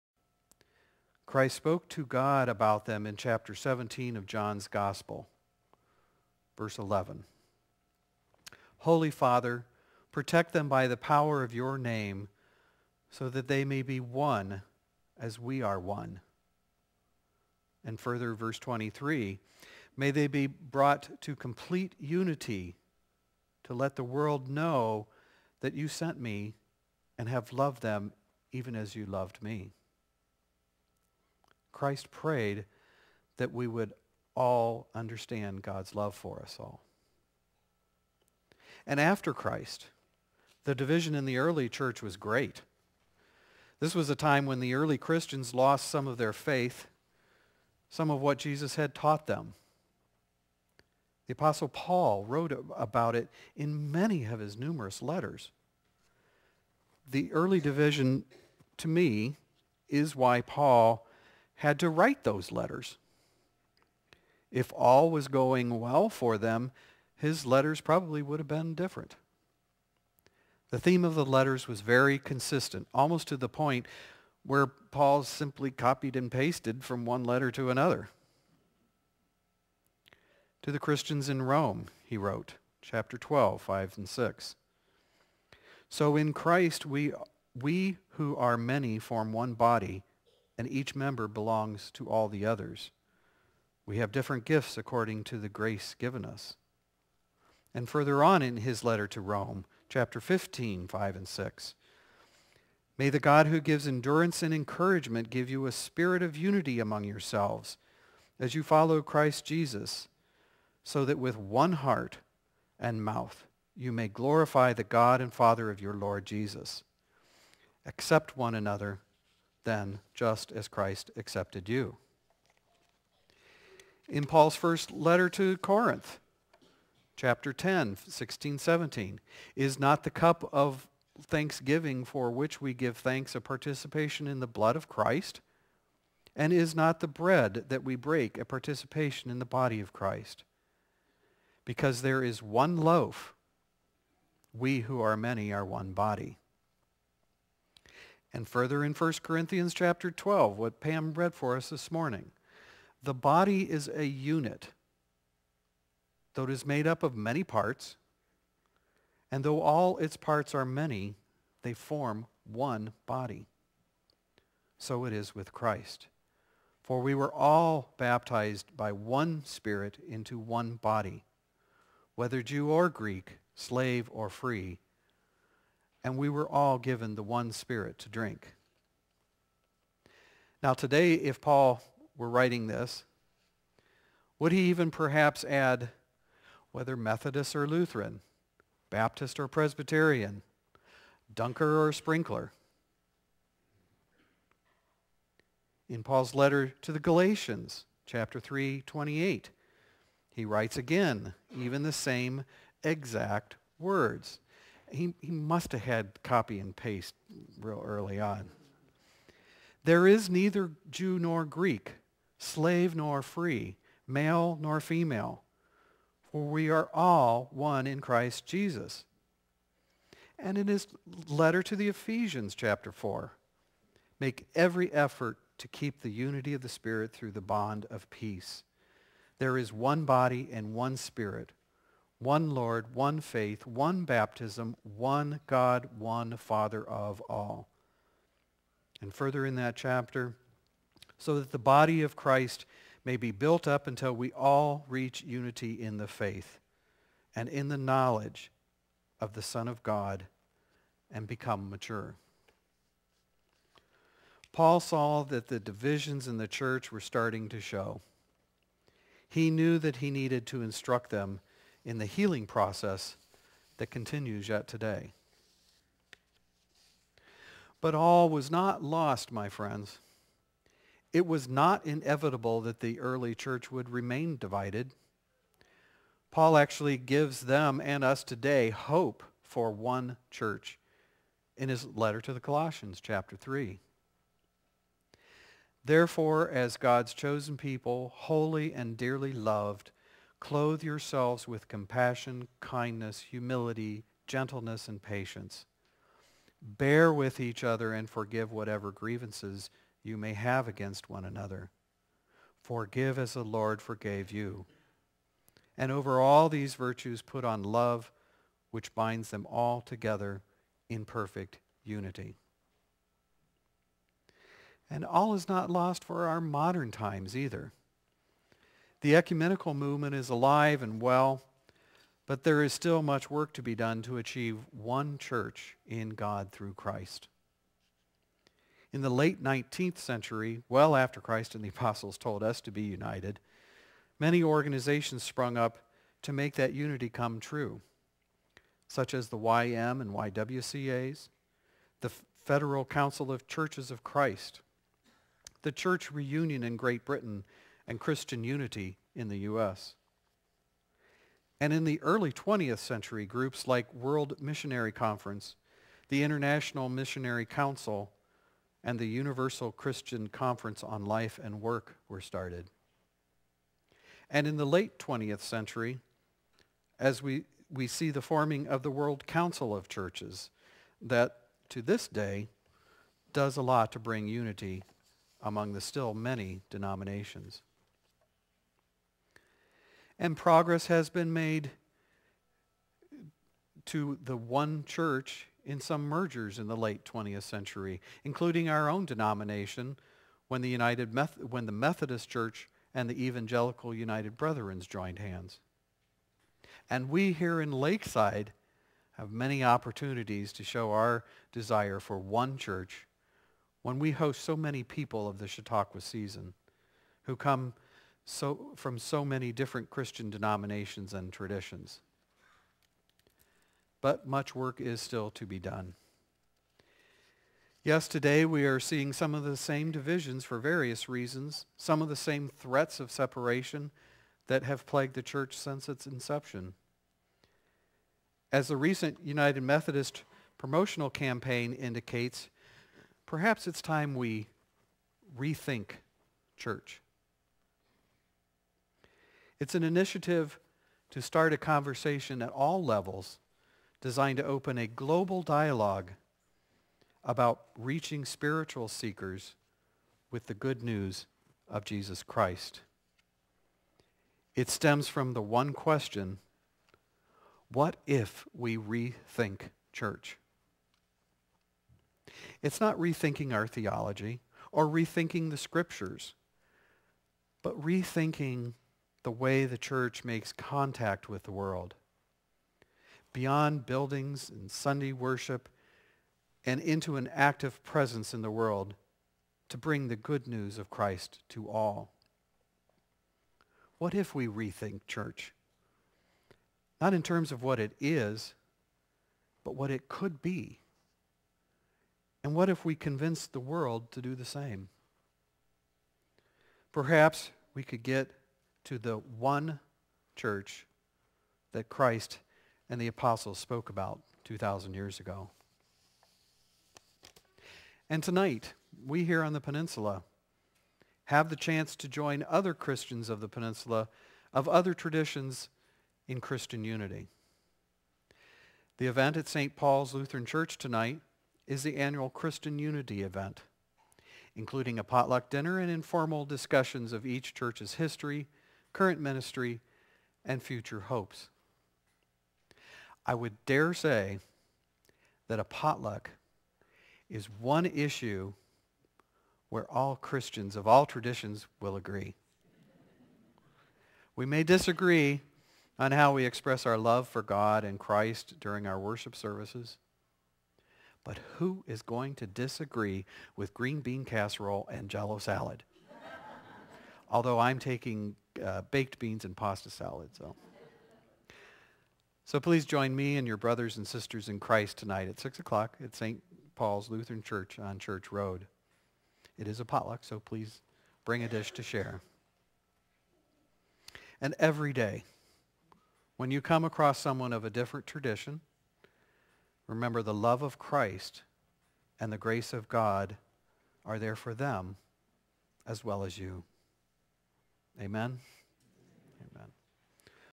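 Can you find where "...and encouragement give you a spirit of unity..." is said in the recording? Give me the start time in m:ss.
1:44.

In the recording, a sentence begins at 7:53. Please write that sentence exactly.
Beyond buildings and Sunday worship and into an active presence in the world to bring the good news of Christ to all.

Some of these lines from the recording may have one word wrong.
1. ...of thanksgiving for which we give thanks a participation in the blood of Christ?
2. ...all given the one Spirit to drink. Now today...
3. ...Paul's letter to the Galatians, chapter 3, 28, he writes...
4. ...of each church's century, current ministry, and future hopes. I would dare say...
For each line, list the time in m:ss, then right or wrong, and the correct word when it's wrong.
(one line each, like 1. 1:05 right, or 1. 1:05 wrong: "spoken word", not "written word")
1. 2:10 right
2. 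2:56 right
3. 3:16 right
4. 8:47 wrong: "history", not "century".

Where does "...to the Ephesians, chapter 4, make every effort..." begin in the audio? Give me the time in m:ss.
3:41.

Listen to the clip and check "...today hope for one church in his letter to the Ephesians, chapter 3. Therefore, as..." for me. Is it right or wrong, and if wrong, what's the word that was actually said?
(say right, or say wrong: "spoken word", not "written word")
wrong: "Colossians", not "Ephesians".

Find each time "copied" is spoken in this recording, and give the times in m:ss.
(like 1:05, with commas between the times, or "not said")
1:15.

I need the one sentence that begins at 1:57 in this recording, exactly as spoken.
Accept one another then, just as Christ accepted you.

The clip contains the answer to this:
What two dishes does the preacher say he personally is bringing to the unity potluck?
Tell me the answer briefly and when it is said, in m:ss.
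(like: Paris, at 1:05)
Baked beans and pasta salad, at 9:18.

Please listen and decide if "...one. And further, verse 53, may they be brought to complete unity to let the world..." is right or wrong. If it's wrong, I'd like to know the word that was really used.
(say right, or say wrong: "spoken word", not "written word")
wrong: "23", not "53".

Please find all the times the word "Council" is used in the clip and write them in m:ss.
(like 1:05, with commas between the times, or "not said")
5:42, 5:57, 6:09.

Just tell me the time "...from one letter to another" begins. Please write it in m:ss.
1:16.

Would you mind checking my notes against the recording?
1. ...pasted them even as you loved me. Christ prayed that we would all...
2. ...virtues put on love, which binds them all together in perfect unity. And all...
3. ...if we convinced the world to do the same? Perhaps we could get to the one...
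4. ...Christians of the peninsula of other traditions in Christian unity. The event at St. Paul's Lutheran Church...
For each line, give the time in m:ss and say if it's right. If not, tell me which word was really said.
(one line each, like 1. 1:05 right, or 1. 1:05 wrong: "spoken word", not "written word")
1. 0:27 wrong: "loved", not "pasted"
2. 5:06 right
3. 8:12 right
4. 8:32 right.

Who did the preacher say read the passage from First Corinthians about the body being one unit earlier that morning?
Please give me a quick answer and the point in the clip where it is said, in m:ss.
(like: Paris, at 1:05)
Pam, at 2:30.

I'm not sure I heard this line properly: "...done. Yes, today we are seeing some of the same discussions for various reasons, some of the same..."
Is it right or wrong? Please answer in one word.
wrong.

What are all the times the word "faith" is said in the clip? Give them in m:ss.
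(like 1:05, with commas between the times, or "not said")
0:46, 3:53, 4:06.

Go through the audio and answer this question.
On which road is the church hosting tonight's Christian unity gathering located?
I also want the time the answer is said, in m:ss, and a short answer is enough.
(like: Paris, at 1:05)
Church Road, at 9:27.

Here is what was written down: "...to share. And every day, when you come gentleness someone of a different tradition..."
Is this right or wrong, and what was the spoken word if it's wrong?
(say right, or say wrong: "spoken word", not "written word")
wrong: "across", not "gentleness".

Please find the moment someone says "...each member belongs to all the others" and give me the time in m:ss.
1:30.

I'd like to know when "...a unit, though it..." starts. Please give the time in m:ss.
2:33.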